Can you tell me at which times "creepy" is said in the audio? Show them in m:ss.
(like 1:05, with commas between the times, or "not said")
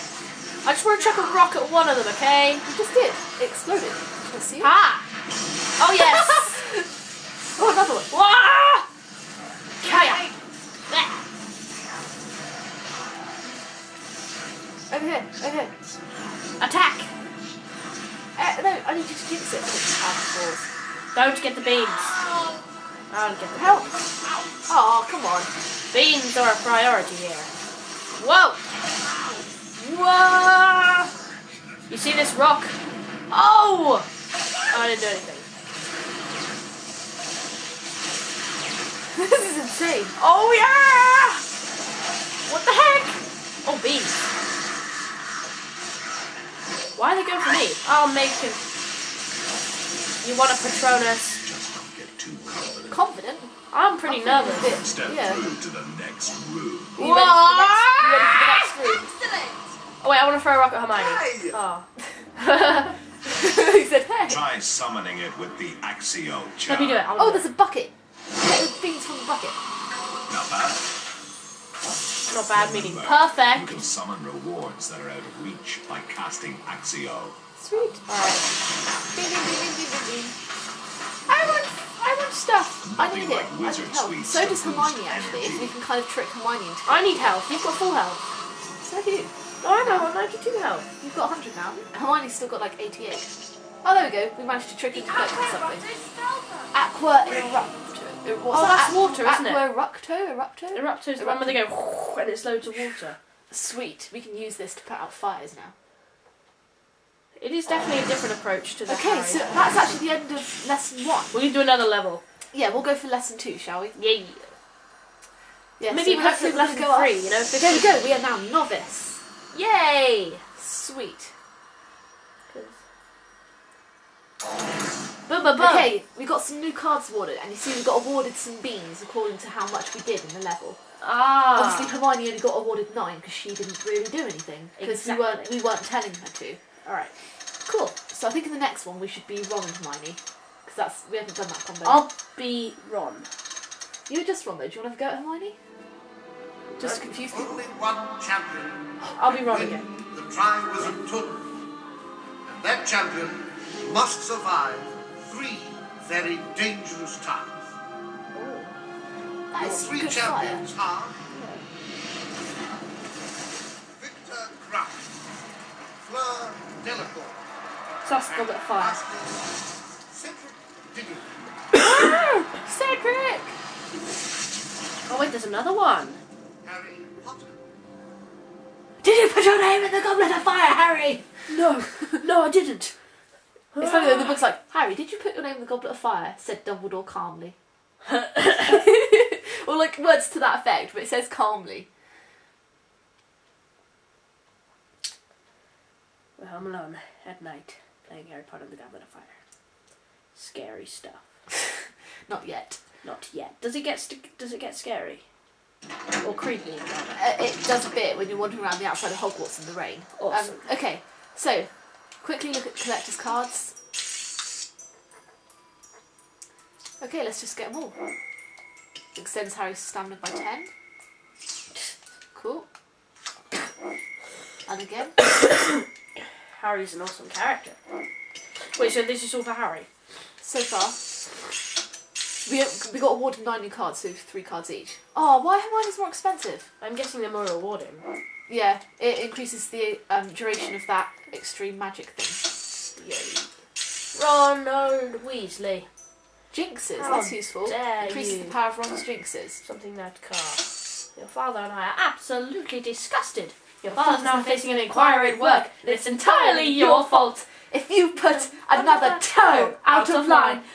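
3:26.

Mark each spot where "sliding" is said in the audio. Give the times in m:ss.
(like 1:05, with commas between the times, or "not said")
not said.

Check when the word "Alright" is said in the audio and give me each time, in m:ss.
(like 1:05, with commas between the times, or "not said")
1:18, 2:16.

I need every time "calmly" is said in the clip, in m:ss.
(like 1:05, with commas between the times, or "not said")
3:07, 3:11.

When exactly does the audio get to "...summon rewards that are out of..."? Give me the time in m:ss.
1:13.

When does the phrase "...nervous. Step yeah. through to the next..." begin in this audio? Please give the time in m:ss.
0:54.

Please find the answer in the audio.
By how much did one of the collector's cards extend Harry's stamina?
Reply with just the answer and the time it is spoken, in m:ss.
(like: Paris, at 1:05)
10, at 3:40.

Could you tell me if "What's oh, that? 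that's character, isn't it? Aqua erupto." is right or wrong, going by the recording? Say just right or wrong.
wrong.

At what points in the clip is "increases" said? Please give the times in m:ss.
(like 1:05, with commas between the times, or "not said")
3:59, 4:07.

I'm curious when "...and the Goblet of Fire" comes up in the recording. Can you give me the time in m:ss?
3:18.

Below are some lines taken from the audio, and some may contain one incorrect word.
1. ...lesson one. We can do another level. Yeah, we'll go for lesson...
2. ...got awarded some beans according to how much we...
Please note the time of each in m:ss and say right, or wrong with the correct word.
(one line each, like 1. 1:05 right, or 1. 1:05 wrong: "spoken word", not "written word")
1. 1:50 right
2. 2:07 right.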